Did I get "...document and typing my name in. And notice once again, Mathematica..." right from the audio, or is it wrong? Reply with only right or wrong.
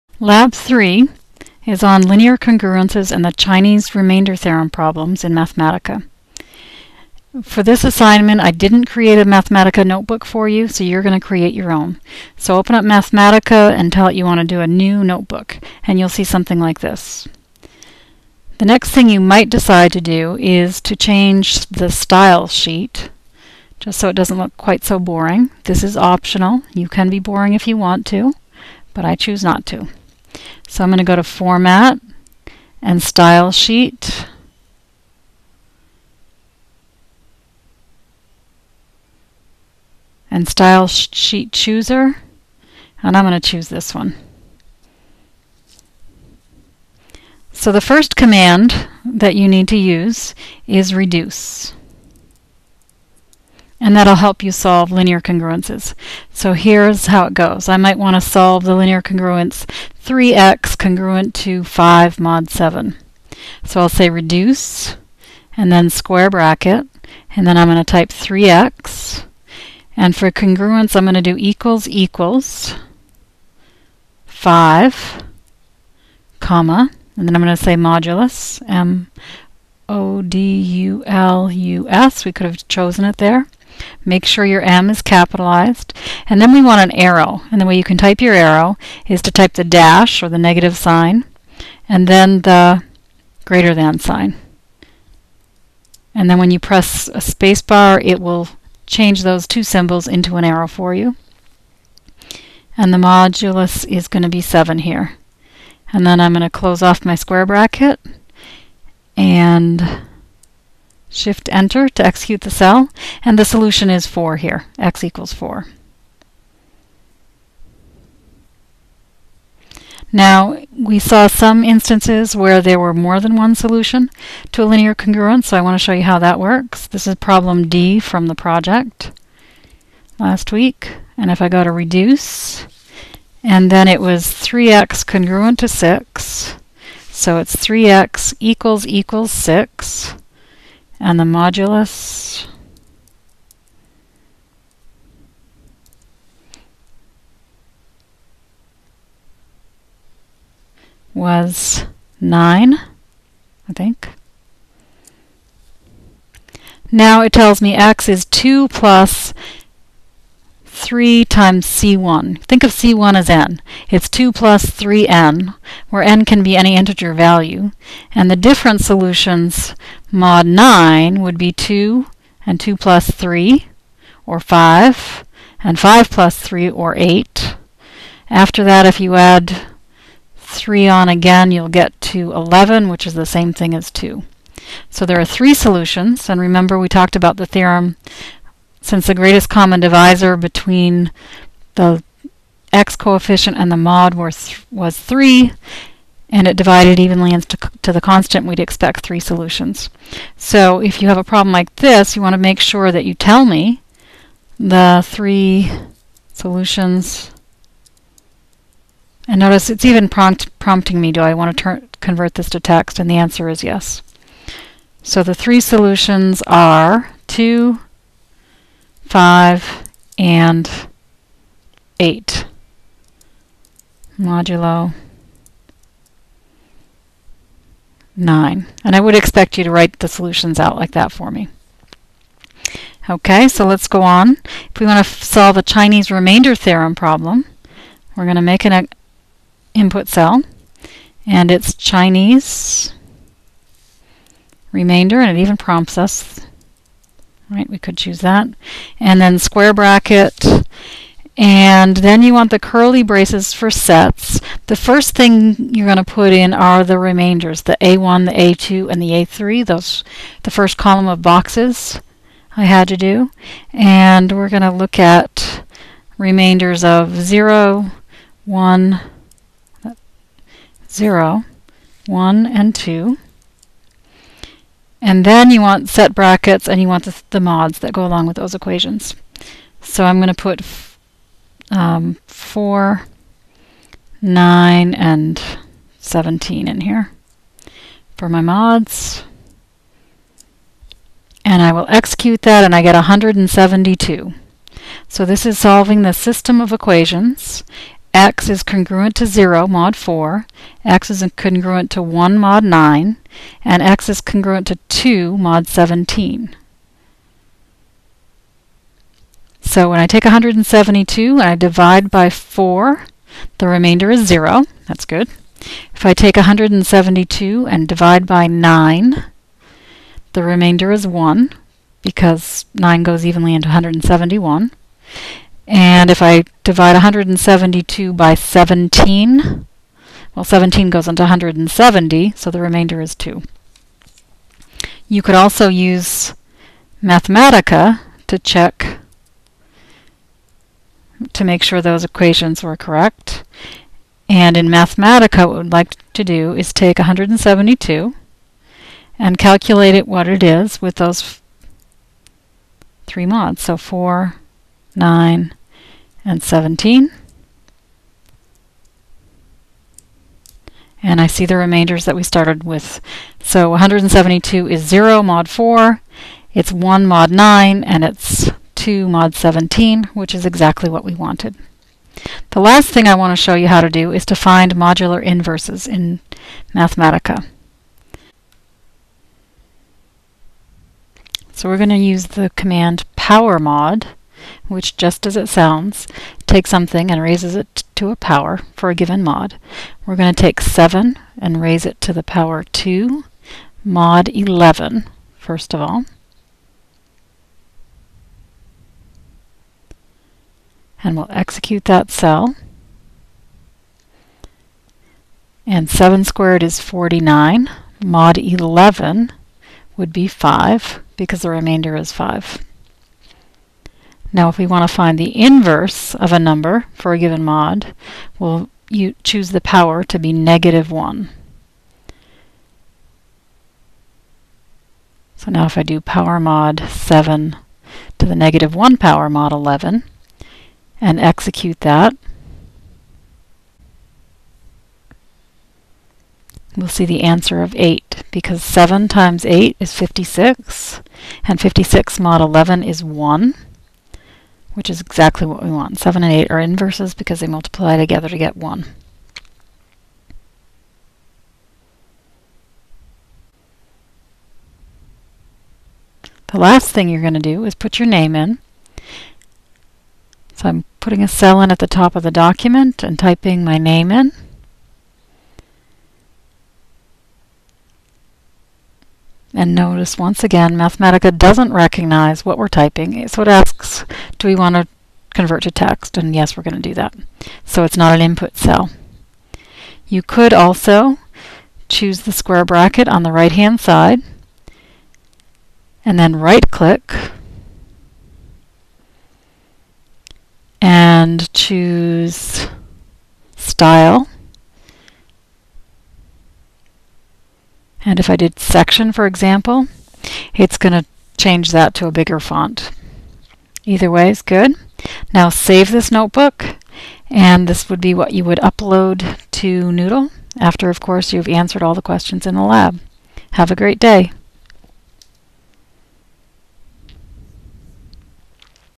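right.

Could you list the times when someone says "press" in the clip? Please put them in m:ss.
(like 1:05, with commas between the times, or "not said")
1:36.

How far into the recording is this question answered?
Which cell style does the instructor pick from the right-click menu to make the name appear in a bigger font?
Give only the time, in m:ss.
8:18.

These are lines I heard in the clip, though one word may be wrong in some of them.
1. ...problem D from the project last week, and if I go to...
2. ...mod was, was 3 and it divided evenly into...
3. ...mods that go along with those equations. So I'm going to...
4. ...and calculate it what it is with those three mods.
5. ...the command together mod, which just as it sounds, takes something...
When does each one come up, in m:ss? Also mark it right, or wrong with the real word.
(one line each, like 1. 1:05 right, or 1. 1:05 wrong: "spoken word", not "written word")
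1. 2:07 right
2. 3:13 right
3. 4:37 right
4. 5:49 right
5. 6:22 wrong: "power", not "together".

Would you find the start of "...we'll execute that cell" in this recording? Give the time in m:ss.
6:41.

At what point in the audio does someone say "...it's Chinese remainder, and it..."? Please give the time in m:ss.
4:01.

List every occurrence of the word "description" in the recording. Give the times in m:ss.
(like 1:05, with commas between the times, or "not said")
not said.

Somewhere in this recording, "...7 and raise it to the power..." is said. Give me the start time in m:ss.
6:30.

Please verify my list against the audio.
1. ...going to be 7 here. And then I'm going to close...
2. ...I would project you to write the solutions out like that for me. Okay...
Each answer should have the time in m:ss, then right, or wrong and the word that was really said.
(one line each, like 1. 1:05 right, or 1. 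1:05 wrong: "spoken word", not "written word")
1. 1:44 right
2. 3:48 wrong: "expect", not "project".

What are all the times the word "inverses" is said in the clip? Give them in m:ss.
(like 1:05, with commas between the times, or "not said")
6:15, 6:55, 7:26.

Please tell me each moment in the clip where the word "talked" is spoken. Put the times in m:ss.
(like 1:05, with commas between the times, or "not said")
3:06.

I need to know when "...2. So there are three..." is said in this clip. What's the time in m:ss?
3:03.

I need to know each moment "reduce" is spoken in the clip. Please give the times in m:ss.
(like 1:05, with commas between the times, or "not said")
0:50, 1:04, 2:11.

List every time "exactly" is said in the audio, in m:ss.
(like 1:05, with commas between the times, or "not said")
6:10, 7:25.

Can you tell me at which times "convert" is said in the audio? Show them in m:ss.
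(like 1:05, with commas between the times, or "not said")
3:31, 7:55.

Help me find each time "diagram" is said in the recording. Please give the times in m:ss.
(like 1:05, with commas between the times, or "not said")
not said.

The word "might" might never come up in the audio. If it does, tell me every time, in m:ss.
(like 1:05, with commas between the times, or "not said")
0:19, 0:57.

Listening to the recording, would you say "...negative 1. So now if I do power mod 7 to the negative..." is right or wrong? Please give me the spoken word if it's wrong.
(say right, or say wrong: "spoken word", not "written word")
right.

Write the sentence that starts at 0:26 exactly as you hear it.
You can be boring if you want to, but I choose not to.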